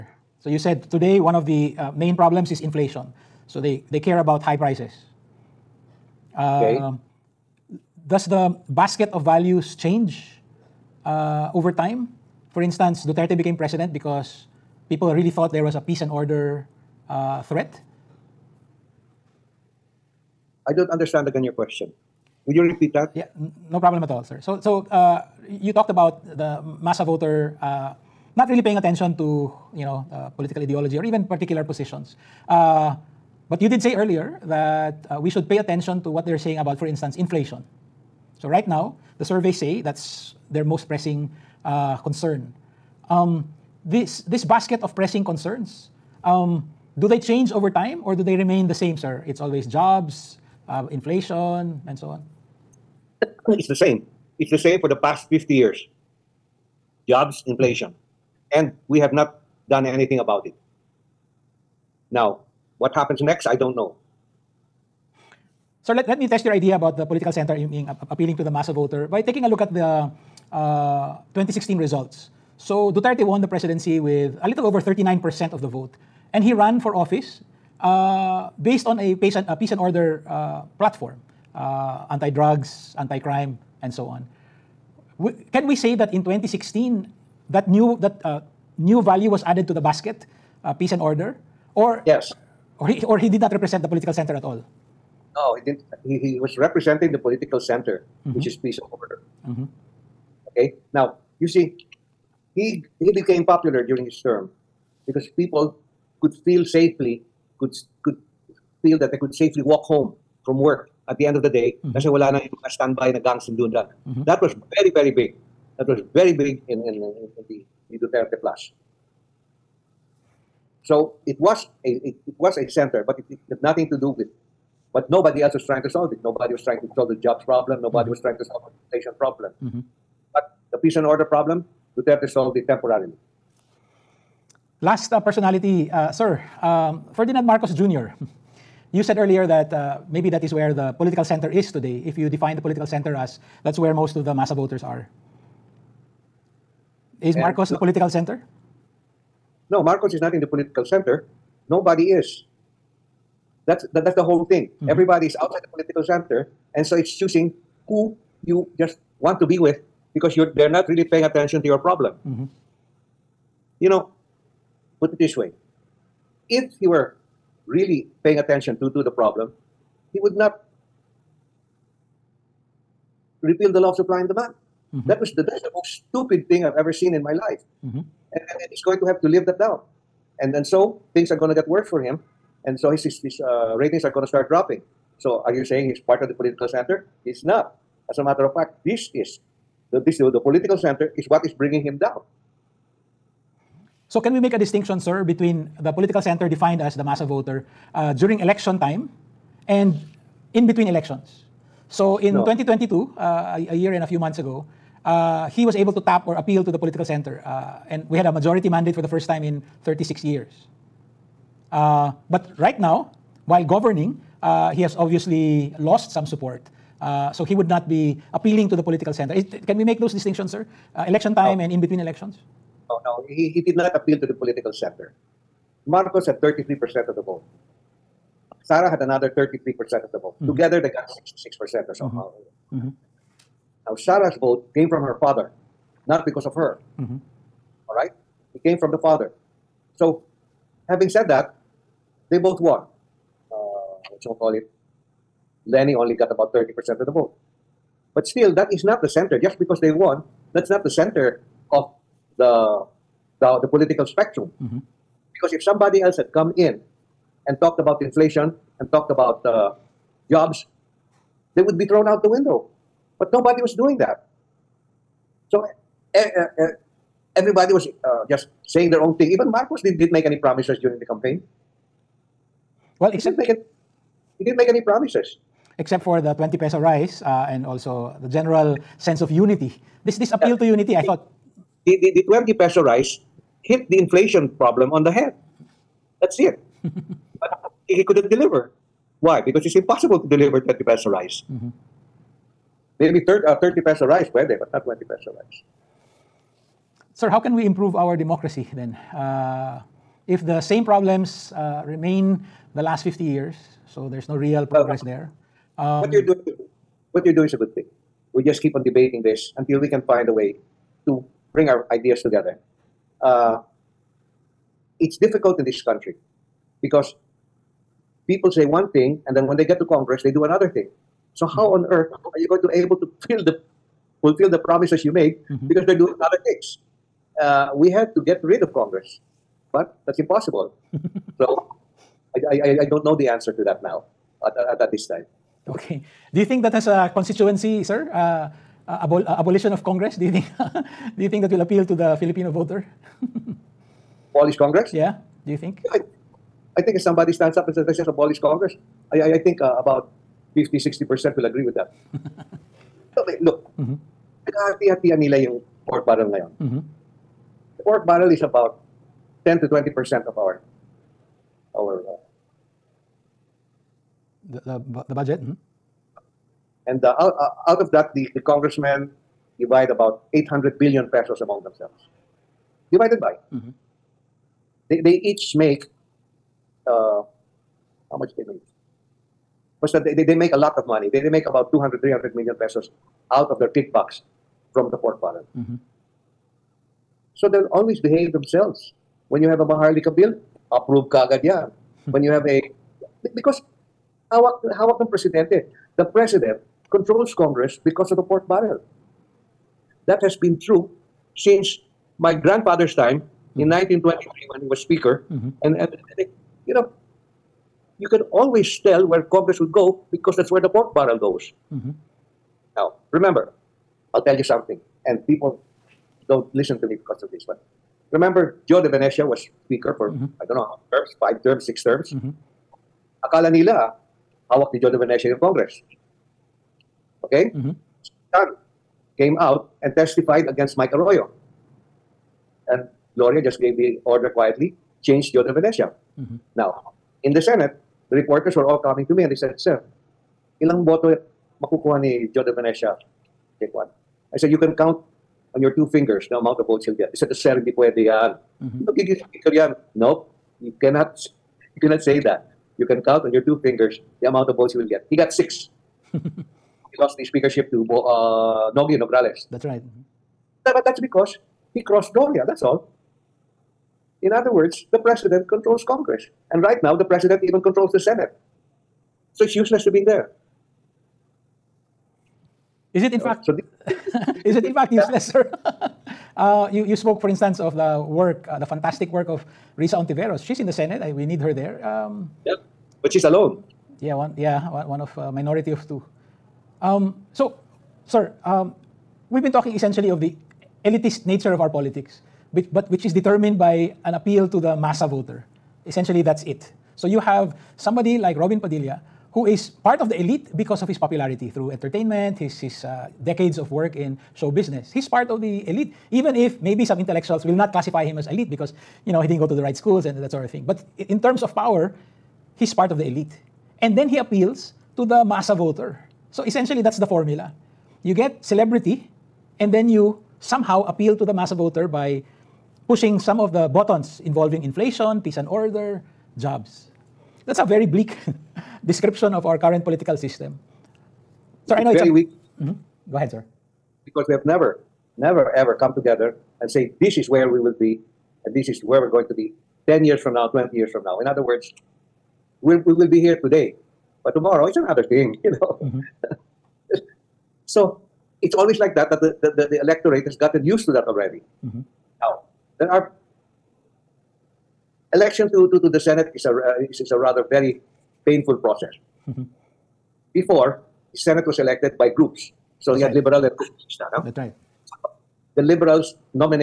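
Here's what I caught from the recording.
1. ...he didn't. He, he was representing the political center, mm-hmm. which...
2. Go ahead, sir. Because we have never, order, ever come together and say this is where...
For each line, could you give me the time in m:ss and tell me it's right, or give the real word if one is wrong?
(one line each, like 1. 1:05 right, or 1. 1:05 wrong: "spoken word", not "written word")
1. 1:35 right
2. 8:53 wrong: "never", not "order".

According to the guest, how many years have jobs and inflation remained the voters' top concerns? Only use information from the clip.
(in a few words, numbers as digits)
50 years.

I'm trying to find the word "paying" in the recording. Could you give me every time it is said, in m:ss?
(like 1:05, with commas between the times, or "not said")
0:28, 2:41, 2:48.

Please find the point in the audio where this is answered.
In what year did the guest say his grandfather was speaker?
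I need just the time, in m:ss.
6:43.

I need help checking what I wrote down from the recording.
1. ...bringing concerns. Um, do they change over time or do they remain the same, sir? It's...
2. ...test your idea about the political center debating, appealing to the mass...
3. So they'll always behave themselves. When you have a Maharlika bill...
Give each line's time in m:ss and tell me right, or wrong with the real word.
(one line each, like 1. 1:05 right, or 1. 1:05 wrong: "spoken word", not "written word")
1. 0:44 wrong: "pressing", not "bringing"
2. 1:06 wrong: "aiming", not "debating"
3. 6:27 right.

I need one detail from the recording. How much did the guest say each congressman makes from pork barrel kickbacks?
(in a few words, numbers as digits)
200-300 million pesos.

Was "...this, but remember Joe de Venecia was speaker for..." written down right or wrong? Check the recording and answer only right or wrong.
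right.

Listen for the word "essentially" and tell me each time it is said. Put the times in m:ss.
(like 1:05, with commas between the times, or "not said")
8:09, 8:15, 8:36.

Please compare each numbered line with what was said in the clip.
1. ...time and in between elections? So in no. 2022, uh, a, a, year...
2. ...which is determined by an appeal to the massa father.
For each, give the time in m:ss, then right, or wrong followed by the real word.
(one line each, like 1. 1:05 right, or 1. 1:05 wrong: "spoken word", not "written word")
1. 3:18 right
2. 8:12 wrong: "voter", not "father".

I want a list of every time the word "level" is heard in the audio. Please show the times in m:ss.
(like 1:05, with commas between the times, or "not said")
not said.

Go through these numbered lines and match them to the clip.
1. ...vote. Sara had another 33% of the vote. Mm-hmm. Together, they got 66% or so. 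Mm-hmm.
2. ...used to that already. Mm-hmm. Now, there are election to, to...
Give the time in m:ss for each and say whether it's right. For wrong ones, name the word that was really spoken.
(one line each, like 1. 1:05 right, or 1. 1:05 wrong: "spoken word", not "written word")
1. 3:47 right
2. 9:10 right.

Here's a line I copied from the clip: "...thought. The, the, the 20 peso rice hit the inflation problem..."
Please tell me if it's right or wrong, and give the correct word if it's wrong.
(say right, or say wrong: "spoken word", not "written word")
right.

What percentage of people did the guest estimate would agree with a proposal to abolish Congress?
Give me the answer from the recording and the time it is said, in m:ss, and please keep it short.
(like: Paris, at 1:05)
50 to 60%, at 5:49.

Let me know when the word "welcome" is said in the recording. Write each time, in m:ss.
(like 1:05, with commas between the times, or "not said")
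not said.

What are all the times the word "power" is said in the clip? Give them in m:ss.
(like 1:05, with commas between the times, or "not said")
8:31.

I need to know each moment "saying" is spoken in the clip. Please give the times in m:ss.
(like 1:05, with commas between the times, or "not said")
0:36, 3:05, 4:28.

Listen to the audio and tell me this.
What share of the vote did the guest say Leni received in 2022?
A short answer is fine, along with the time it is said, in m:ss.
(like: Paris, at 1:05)
about 30%, at 4:06.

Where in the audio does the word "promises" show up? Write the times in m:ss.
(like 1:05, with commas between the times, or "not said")
4:30, 4:34, 5:24.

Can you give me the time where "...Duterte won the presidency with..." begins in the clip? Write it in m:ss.
1:12.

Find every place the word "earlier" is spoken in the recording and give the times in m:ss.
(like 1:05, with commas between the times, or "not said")
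0:33, 2:19.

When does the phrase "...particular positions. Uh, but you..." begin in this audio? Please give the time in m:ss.
0:31.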